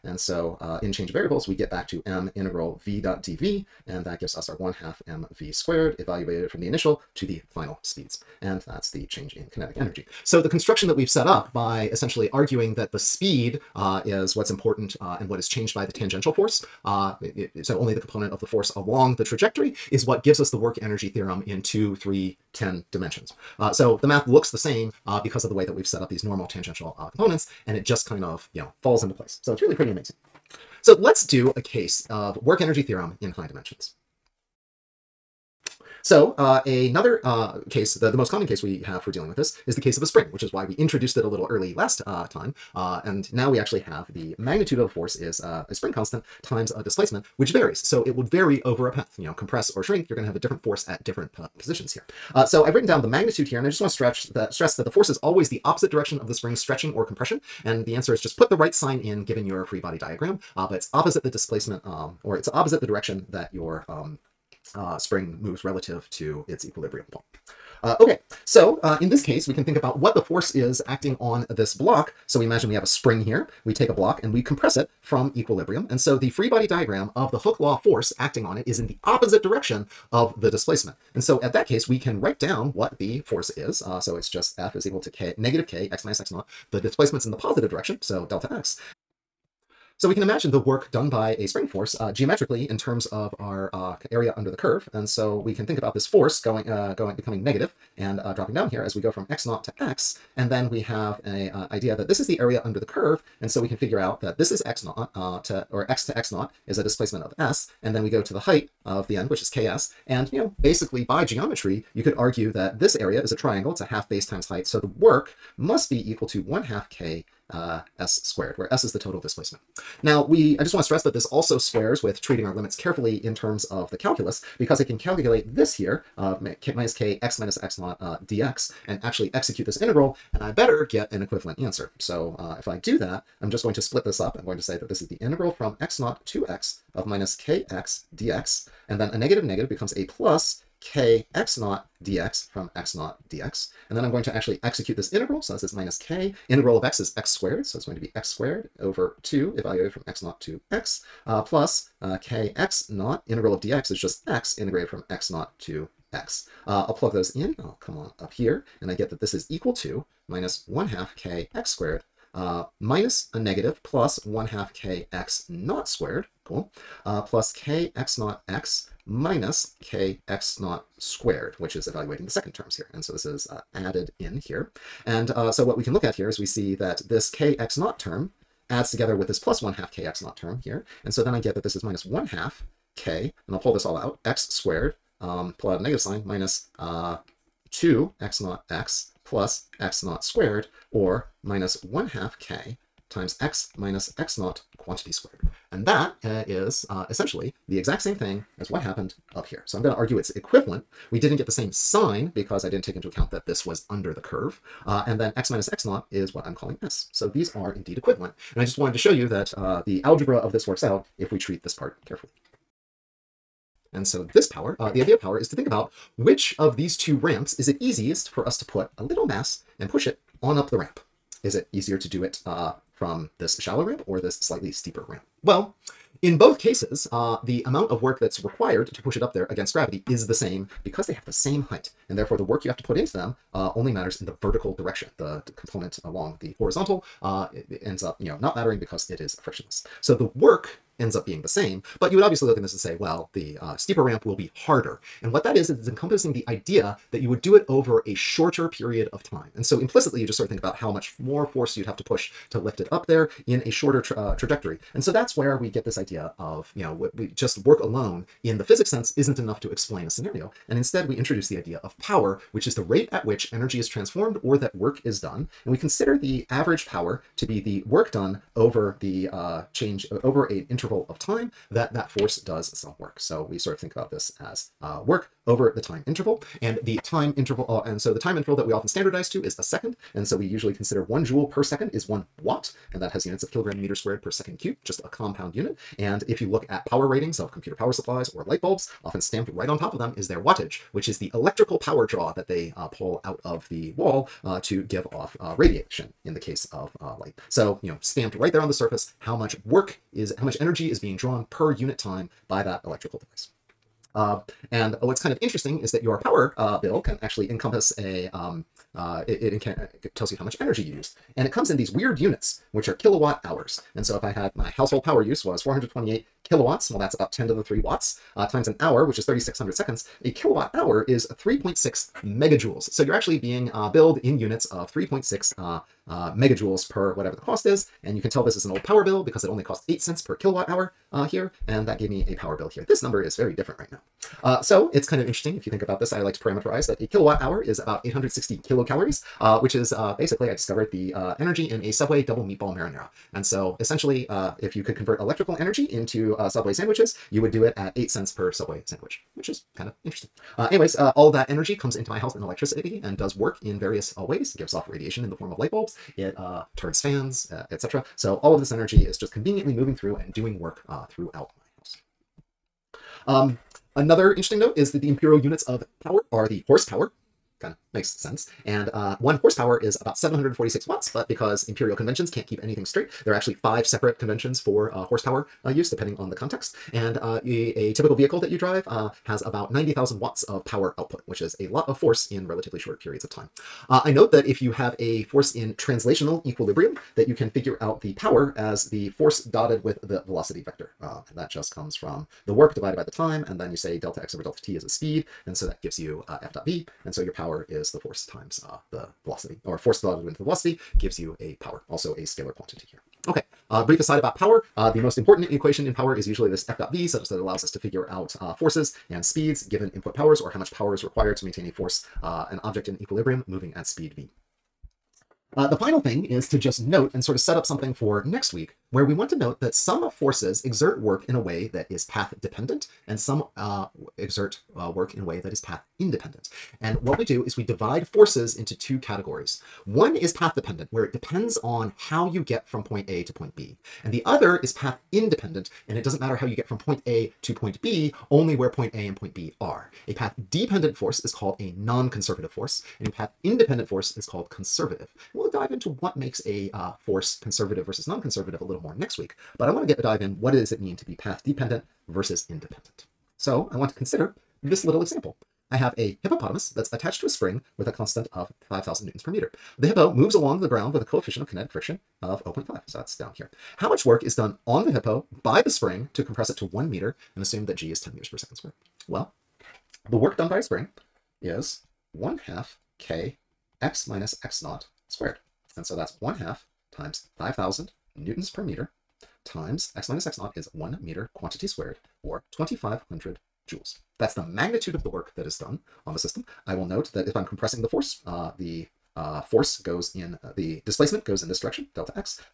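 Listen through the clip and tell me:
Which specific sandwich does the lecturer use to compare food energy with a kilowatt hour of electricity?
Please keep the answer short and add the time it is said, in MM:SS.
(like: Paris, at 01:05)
Subway double meatball marinara, at 05:41.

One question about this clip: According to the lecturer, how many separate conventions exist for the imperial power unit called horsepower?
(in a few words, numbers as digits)
5.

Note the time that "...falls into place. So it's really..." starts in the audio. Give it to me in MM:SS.
00:28.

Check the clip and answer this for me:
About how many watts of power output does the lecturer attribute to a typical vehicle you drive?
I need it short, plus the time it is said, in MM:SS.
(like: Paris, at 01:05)
90,000, at 06:19.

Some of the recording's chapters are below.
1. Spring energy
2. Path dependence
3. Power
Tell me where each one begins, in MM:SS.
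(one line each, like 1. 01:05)
1. 00:34
2. 06:55
3. 03:33.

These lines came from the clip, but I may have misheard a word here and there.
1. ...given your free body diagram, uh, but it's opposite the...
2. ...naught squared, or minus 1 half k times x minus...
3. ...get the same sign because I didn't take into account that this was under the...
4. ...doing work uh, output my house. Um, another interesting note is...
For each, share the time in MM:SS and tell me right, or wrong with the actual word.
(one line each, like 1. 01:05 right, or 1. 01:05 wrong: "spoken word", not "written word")
1. 00:59 right
2. 03:10 right
3. 03:21 right
4. 06:00 wrong: "throughout", not "output".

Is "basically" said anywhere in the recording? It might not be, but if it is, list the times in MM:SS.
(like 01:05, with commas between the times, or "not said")
01:50, 05:40.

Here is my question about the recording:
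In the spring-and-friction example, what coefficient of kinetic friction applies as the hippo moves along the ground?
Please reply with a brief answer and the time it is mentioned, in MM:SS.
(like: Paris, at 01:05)
0.5, at 07:42.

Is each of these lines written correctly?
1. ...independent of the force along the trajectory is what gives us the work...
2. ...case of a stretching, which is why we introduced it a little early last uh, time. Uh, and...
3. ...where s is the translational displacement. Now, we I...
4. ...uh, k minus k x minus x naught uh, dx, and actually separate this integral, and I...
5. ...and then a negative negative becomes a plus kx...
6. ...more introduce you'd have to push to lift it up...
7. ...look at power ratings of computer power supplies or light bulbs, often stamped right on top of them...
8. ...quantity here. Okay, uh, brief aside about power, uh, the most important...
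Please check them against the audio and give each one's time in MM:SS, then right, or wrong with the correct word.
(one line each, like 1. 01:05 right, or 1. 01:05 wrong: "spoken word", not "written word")
1. 00:17 wrong: "component", not "independent"
2. 00:39 wrong: "spring", not "stretching"
3. 01:58 wrong: "total", not "translational"
4. 02:06 wrong: "execute", not "separate"
5. 02:18 right
6. 04:11 wrong: "force", not "introduce"
7. 04:46 right
8. 06:42 right.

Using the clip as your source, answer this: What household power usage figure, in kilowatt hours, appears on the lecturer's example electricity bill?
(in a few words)
428.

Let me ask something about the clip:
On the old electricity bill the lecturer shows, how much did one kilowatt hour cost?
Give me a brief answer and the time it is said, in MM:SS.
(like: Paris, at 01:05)
8 cents, at 05:29.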